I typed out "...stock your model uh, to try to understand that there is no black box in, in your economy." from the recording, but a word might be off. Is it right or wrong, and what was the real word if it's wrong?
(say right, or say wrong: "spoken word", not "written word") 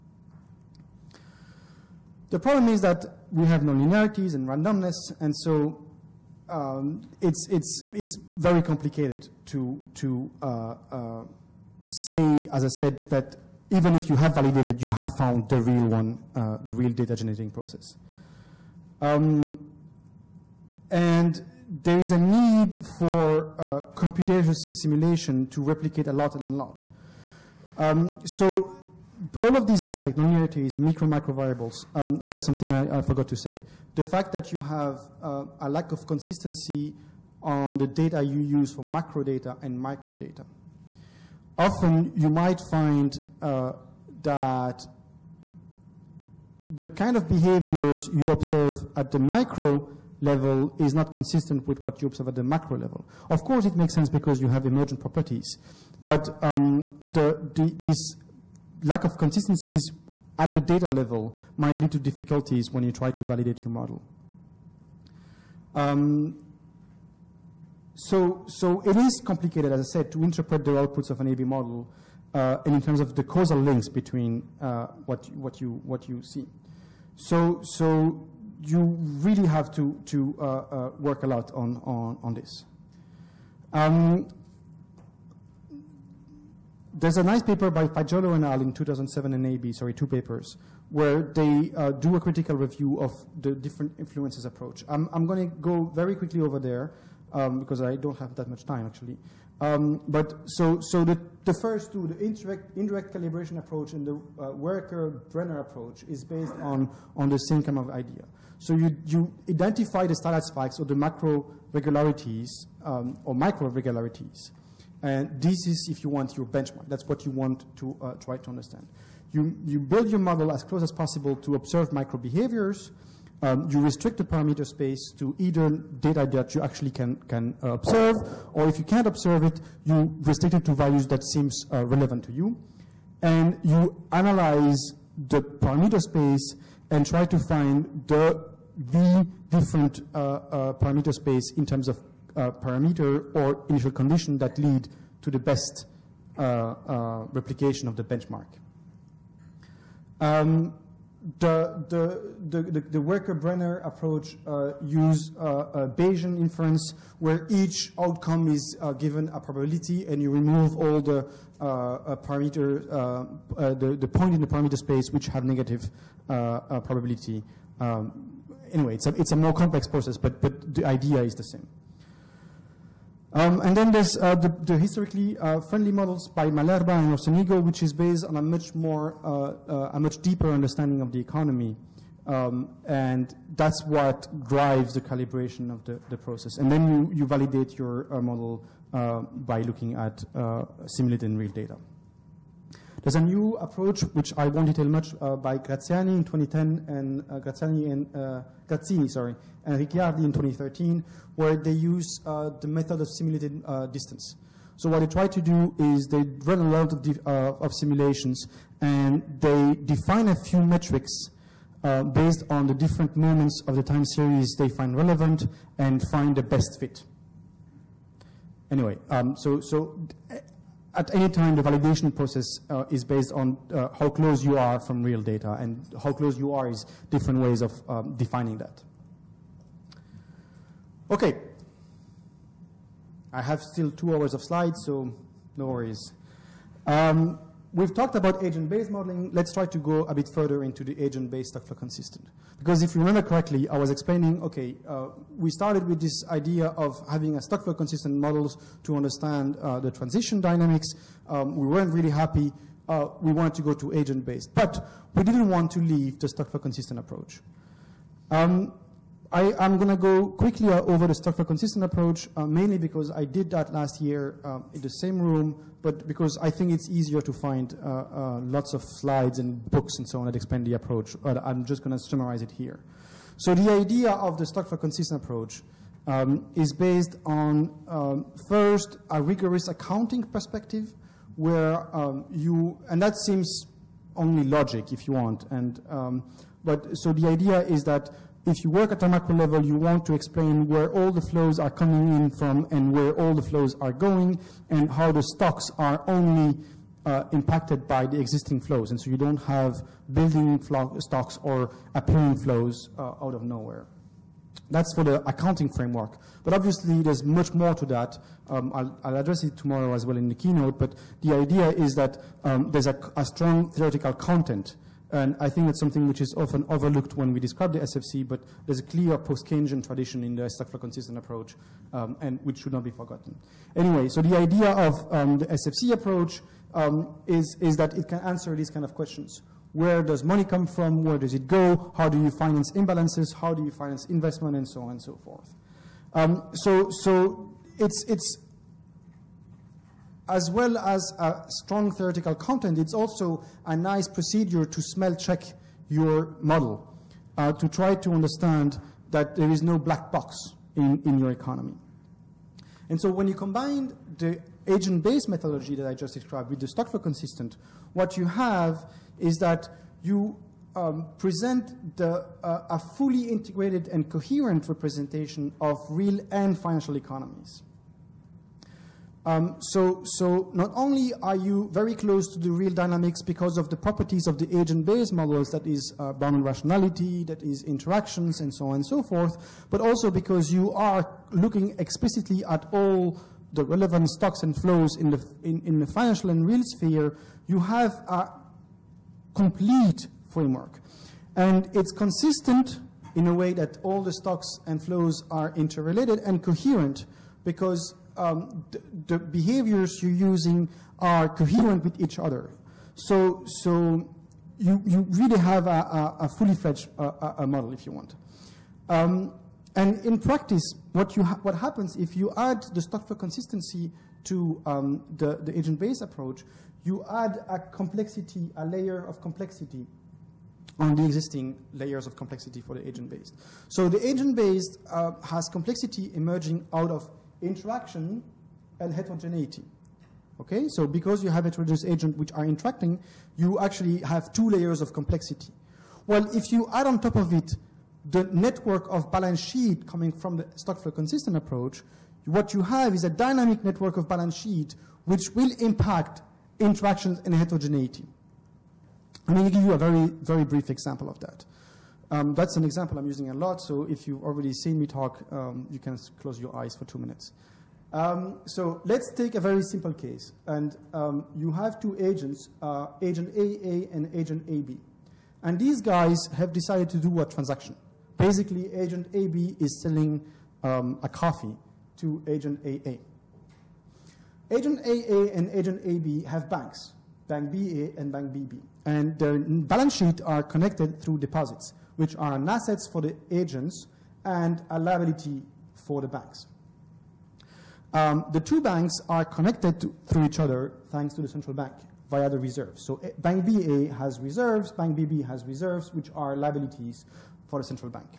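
wrong: "check", not "stock".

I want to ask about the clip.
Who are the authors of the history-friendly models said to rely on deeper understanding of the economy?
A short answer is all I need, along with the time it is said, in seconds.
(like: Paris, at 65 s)
Malerba and Orsenigo, at 176 s.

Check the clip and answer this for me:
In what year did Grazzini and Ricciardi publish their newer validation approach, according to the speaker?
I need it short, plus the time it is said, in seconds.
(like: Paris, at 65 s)
2013, at 200 s.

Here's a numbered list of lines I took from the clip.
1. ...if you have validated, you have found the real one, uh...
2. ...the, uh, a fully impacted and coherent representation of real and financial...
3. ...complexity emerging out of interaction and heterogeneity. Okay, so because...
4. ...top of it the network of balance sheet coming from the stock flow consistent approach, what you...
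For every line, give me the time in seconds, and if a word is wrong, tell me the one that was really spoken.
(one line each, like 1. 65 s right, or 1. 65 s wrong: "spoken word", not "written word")
1. 13 s right
2. 361 s wrong: "integrated", not "impacted"
3. 425 s right
4. 436 s right.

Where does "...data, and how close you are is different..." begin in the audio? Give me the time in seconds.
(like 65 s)
225 s.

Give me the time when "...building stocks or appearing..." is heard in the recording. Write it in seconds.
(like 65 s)
300 s.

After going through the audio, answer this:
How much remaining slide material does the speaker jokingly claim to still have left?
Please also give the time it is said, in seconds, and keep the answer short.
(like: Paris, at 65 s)
two hours, at 233 s.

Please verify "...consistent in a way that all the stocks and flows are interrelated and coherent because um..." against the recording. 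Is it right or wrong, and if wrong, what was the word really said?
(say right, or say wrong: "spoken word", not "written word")
right.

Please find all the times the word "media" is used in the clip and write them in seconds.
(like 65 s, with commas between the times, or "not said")
not said.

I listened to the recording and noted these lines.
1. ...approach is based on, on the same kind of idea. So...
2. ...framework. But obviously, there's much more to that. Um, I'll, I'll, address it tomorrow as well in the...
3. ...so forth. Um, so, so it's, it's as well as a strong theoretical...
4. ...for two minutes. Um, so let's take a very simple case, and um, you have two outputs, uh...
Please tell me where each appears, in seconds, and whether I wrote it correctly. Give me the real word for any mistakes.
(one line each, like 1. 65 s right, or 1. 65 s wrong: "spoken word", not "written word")
1. 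105 s right
2. 305 s right
3. 335 s right
4. 456 s wrong: "agents", not "outputs".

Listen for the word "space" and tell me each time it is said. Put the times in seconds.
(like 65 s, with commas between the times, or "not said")
124 s, 135 s, 141 s, 164 s.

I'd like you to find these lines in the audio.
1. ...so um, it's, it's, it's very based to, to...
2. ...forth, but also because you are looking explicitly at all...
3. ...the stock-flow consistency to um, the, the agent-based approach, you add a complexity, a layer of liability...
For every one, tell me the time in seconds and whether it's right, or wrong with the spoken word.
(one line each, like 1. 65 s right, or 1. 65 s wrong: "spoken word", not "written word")
1. 5 s wrong: "complicated", not "based"
2. 379 s right
3. 412 s wrong: "complexity", not "liability".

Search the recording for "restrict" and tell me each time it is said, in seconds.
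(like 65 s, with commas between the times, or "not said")
123 s, 130 s.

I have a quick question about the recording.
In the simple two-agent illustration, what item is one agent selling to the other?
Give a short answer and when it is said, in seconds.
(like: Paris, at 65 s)
a coffee, at 471 s.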